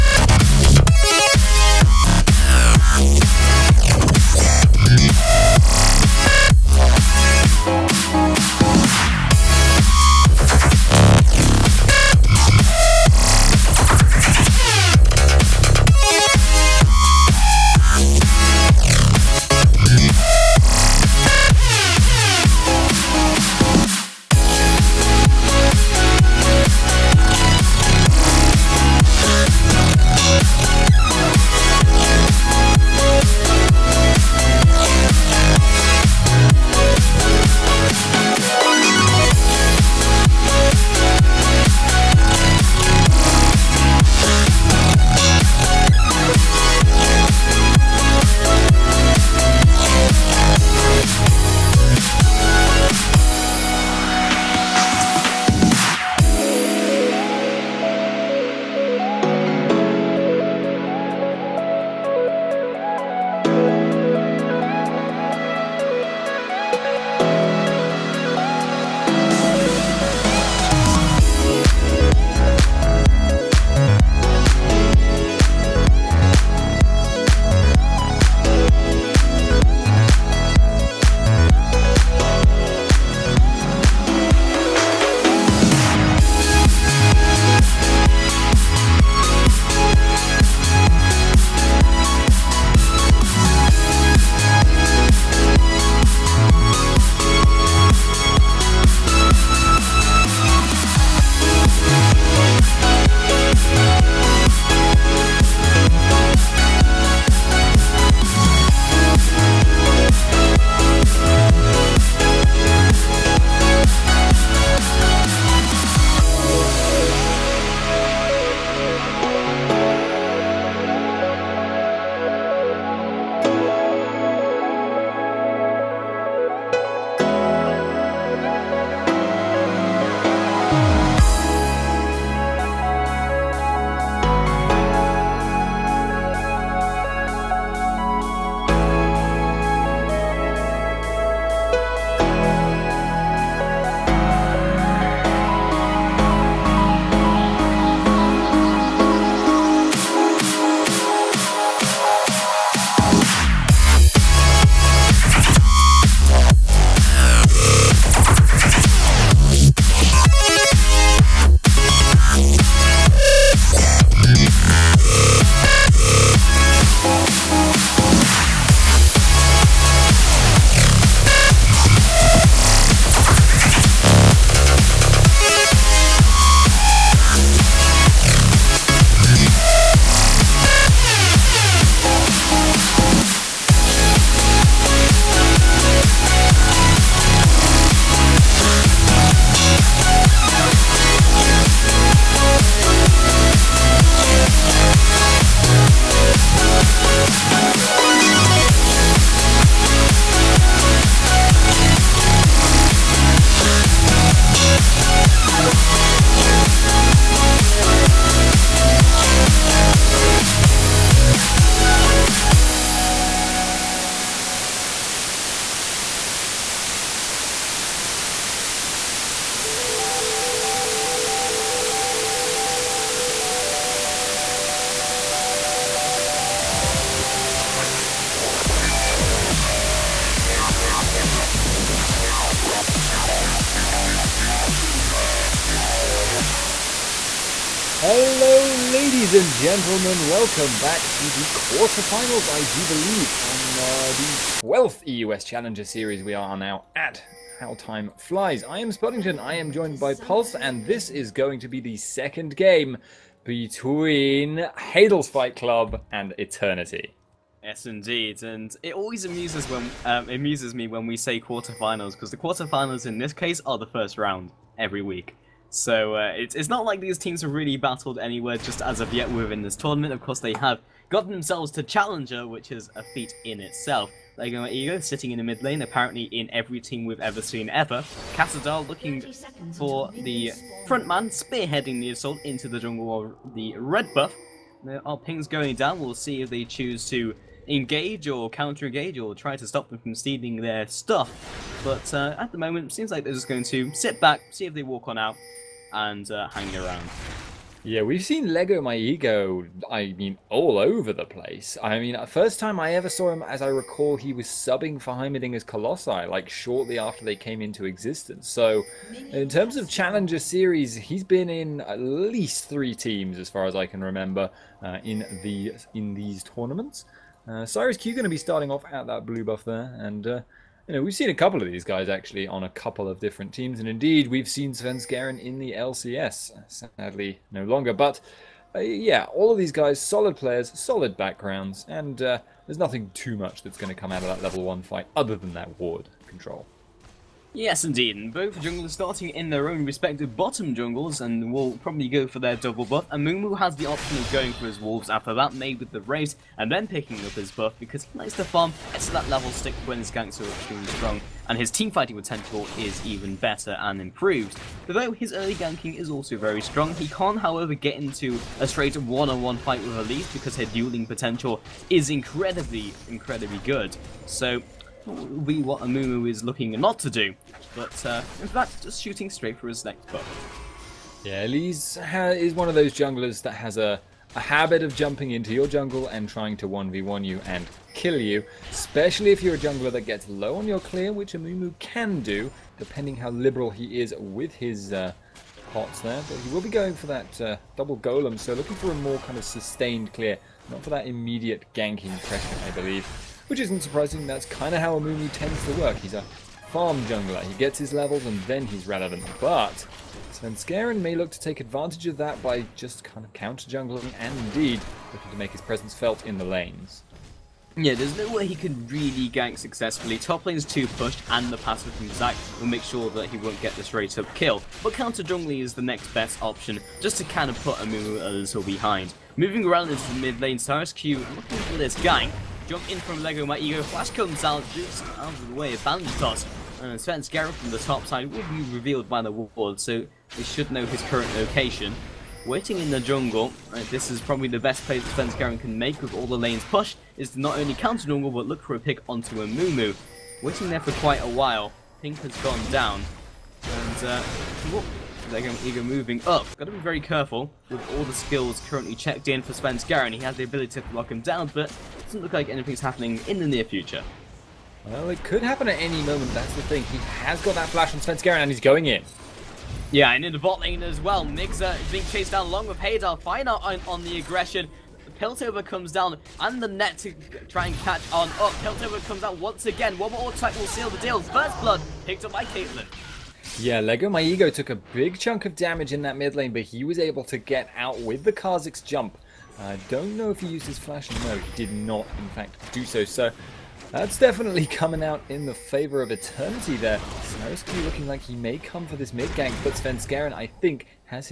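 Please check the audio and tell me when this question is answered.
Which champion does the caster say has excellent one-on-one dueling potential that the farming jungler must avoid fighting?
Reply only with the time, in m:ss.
5:59.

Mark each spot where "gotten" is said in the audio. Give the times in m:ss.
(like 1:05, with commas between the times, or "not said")
4:31.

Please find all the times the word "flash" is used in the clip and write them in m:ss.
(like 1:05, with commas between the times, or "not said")
7:03, 7:37, 8:00.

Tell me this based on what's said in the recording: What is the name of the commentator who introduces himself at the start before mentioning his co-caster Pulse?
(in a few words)
Spuddington.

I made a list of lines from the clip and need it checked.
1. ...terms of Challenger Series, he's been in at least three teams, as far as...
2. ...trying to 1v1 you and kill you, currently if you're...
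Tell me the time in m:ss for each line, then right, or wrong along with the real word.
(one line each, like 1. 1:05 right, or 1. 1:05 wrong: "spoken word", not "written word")
1. 5:09 right
2. 6:16 wrong: "especially", not "currently".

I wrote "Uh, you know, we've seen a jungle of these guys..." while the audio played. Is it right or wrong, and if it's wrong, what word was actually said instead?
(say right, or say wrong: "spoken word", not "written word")
wrong: "couple", not "jungle".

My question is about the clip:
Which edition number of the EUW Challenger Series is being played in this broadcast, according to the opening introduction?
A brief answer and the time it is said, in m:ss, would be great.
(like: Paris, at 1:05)
12th, at 4:04.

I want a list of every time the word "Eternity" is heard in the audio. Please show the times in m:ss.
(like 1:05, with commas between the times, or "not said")
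4:16, 8:06.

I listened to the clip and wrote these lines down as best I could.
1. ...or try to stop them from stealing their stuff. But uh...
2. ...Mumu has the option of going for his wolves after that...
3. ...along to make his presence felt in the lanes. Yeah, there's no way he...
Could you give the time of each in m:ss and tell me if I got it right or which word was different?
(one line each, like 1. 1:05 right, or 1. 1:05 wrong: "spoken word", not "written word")
1. 4:49 right
2. 5:43 right
3. 6:45 wrong: "looking", not "along".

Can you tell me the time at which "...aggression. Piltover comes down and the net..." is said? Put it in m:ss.
7:44.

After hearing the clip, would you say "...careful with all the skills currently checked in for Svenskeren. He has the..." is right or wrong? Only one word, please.
right.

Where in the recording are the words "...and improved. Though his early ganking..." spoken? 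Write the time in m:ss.
5:53.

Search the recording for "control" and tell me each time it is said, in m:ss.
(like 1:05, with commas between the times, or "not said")
5:36.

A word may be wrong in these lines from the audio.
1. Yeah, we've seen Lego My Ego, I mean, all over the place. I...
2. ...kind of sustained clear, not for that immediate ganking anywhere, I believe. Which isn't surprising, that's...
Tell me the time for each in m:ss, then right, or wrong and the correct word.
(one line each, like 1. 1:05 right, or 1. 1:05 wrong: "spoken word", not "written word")
1. 4:57 right
2. 6:29 wrong: "pressure", not "anywhere".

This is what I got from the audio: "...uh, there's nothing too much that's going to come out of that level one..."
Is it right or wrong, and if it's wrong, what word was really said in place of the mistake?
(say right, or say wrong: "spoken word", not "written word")
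right.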